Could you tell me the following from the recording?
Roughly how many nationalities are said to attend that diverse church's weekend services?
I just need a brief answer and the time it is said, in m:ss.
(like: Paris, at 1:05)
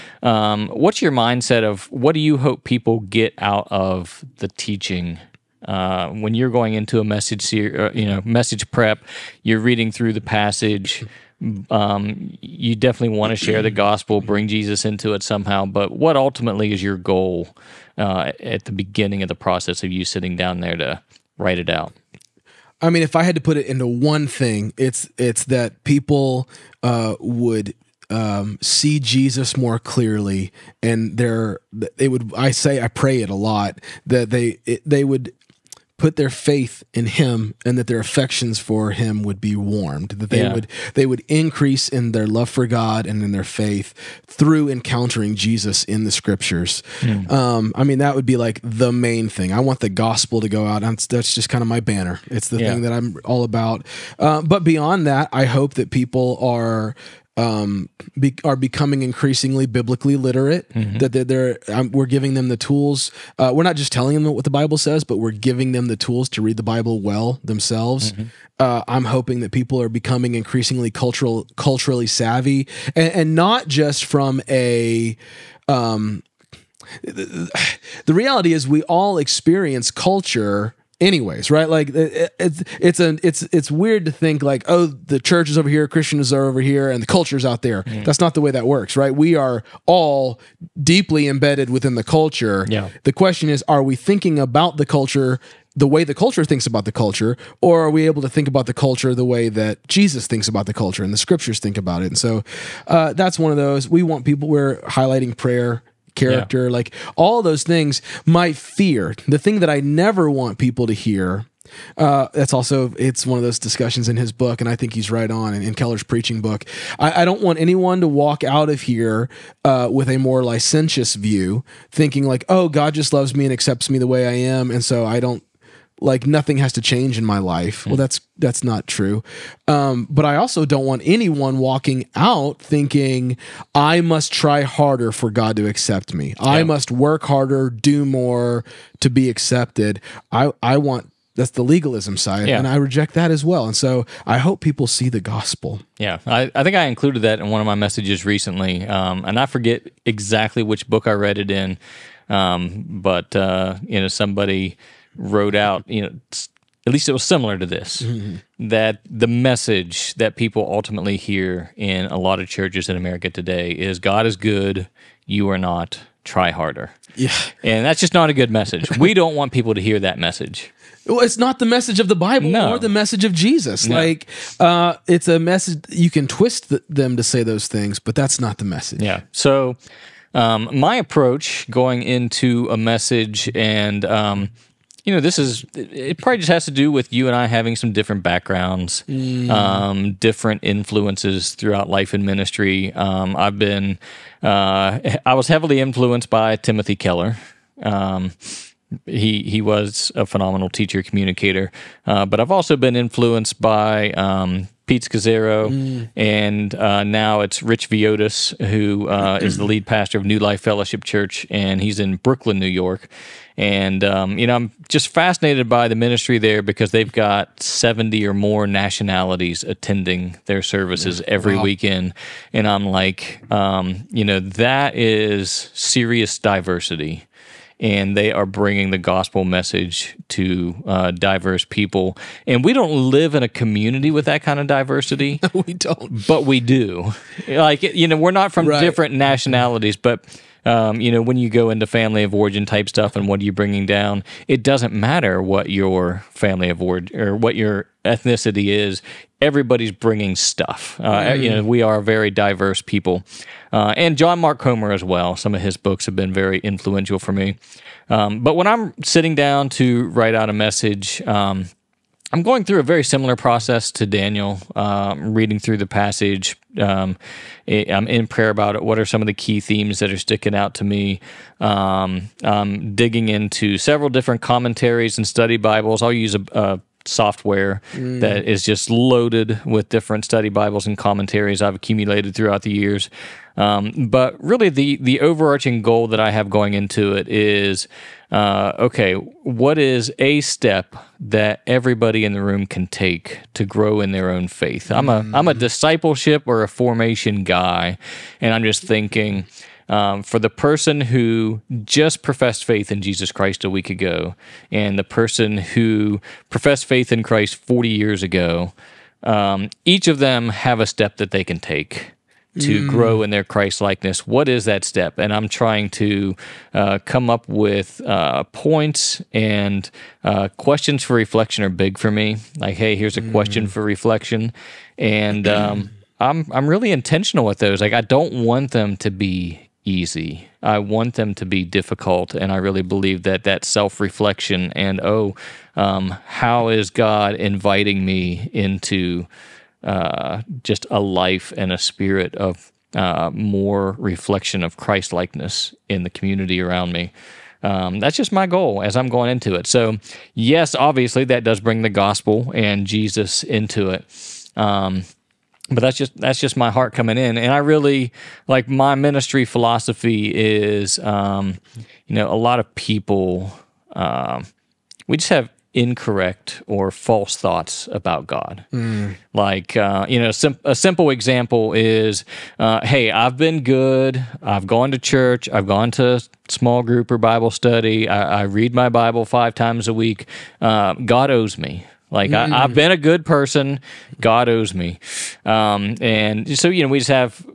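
70, at 3:37.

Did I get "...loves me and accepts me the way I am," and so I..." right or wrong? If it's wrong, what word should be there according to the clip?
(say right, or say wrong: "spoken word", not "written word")
right.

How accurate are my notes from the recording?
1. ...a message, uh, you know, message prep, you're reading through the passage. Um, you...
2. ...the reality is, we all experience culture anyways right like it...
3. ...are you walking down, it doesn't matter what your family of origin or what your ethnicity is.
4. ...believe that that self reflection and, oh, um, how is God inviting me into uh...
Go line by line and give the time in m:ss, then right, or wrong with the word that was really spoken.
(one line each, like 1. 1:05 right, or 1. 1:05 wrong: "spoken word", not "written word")
1. 0:06 right
2. 1:18 right
3. 4:03 wrong: "bringing", not "walking"
4. 5:32 right.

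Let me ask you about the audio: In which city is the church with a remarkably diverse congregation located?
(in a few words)
Brooklyn, New York.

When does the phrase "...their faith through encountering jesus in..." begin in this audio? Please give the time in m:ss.
0:43.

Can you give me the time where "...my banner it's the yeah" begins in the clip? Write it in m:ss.
0:51.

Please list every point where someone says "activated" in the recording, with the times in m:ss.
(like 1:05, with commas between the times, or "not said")
not said.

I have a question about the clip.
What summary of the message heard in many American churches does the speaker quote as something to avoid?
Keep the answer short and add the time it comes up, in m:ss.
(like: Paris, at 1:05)
God is good, you are not, try harder, at 2:43.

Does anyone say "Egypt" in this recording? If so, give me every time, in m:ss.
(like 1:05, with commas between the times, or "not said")
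not said.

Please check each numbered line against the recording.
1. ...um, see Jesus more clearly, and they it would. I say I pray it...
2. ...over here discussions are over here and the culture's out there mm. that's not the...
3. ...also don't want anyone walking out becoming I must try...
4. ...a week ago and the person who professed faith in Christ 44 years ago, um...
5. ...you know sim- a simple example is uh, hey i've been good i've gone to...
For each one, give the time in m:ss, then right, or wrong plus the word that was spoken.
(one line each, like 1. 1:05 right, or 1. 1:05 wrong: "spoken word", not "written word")
1. 0:28 right
2. 1:25 wrong: "christians", not "discussions"
3. 2:10 wrong: "thinking", not "becoming"
4. 5:03 wrong: "40", not "44"
5. 6:10 right.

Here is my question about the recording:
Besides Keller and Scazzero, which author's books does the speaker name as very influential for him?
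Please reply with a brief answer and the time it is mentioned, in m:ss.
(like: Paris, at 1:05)
John Mark Comer, at 4:14.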